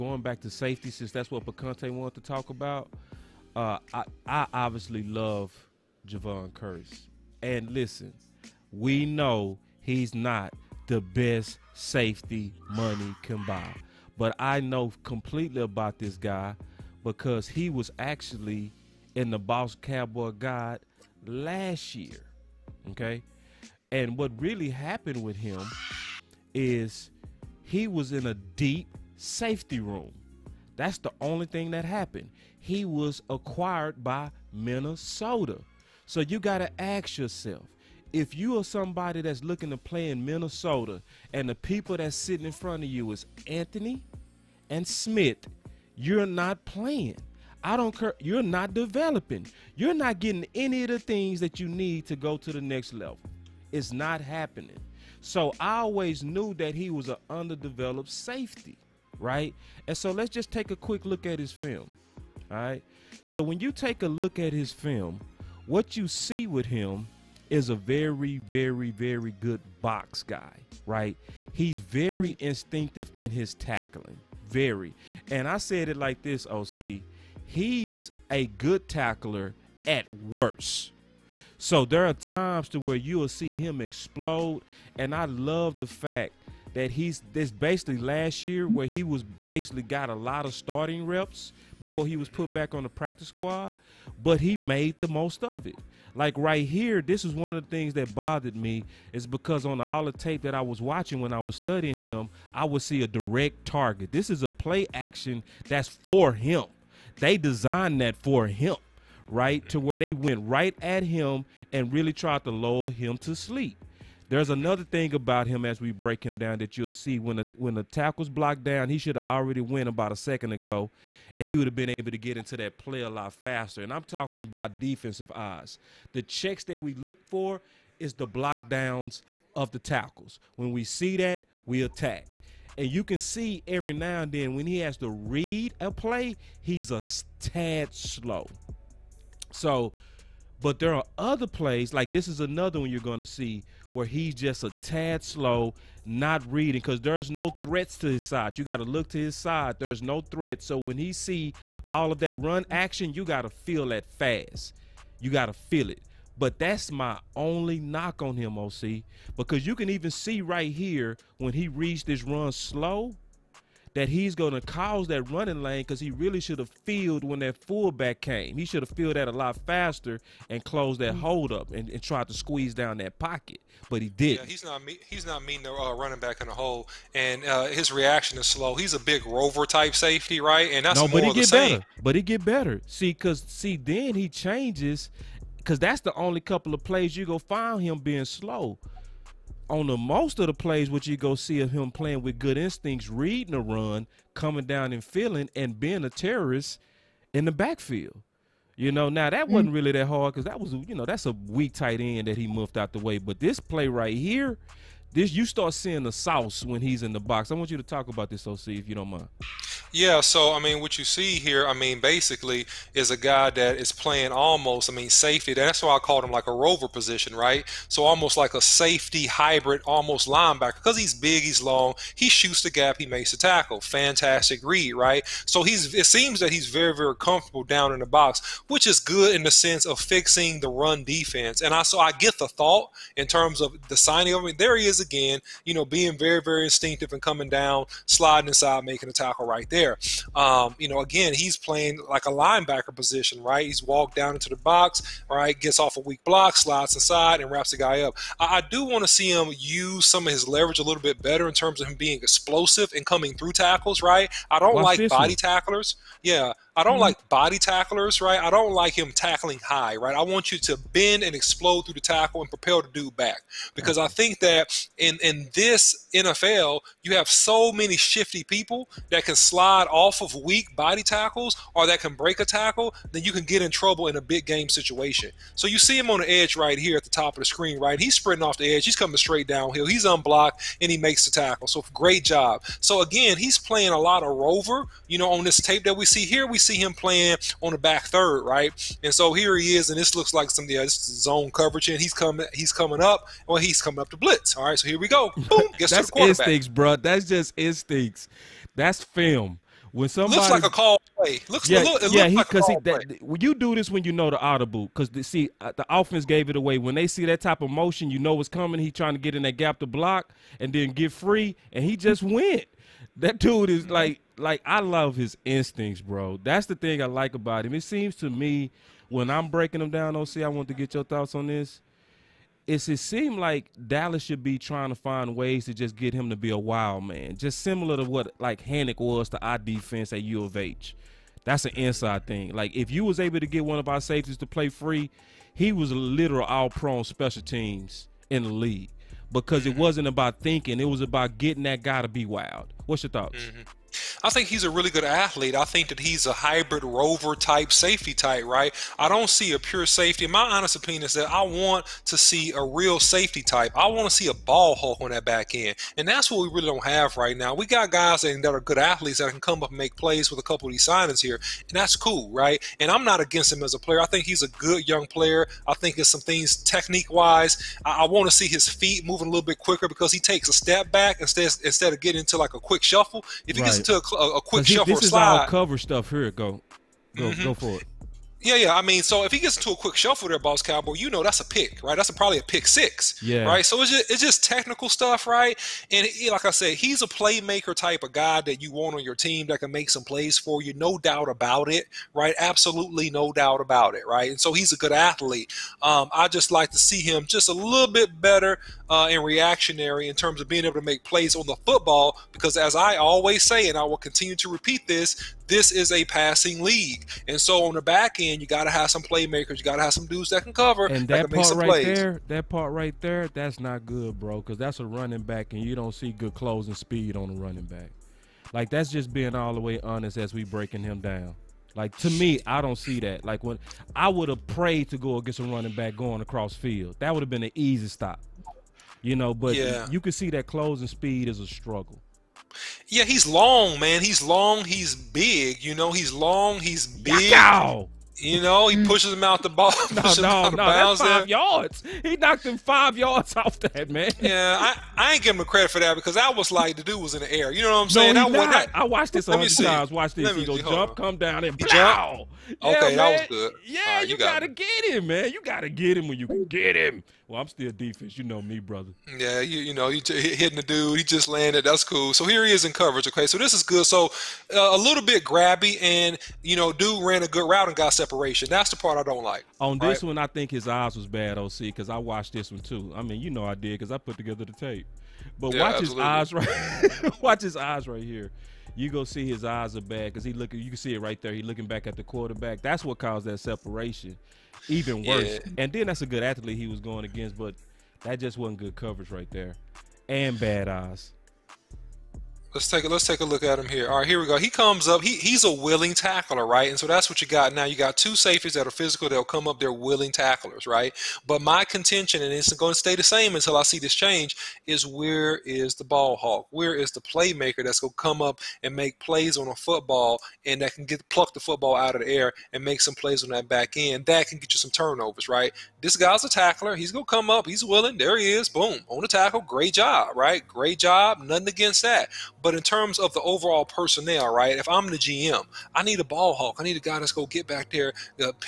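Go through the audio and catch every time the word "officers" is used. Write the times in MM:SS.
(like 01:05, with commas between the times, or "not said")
not said.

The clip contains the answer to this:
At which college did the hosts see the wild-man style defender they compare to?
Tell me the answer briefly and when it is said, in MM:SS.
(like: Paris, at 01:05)
U of H, at 05:30.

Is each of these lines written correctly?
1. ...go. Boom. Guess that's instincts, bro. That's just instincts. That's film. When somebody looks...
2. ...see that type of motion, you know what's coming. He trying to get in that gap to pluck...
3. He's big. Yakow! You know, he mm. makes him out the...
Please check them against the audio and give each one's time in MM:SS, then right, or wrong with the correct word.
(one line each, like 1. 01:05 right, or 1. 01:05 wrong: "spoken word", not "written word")
1. 04:55 right
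2. 05:07 wrong: "block", not "pluck"
3. 07:16 wrong: "pushes", not "makes".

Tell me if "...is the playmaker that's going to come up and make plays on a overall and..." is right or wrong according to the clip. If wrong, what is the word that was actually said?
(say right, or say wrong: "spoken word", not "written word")
wrong: "football", not "overall".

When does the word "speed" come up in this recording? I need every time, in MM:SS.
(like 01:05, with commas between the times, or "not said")
06:56, 07:10.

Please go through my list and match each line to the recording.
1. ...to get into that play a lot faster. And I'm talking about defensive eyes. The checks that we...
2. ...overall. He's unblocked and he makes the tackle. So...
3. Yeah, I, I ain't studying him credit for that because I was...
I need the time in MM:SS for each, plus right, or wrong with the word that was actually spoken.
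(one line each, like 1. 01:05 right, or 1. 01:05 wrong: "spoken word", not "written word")
1. 02:02 right
2. 04:39 wrong: "downhill", not "overall"
3. 07:24 wrong: "giving", not "studying".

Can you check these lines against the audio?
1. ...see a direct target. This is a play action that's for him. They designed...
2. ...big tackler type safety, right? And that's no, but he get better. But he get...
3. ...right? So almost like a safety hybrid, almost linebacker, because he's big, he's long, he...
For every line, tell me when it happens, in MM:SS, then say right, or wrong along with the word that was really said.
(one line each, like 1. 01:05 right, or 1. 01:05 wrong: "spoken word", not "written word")
1. 01:42 right
2. 02:58 wrong: "rover", not "tackler"
3. 03:37 right.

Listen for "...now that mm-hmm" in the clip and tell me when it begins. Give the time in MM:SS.
03:19.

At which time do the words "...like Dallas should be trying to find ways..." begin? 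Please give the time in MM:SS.
05:23.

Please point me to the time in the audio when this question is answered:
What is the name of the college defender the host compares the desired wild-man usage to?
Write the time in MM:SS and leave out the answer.
05:28.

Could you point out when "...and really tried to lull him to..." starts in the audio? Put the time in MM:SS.
01:51.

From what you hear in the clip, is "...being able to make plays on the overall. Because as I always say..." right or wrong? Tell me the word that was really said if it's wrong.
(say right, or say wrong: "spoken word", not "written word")
wrong: "football", not "overall".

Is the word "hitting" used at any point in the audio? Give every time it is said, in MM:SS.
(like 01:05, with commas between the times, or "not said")
07:40.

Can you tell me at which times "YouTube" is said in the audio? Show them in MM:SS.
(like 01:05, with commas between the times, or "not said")
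not said.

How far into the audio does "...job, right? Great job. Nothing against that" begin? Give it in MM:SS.
08:39.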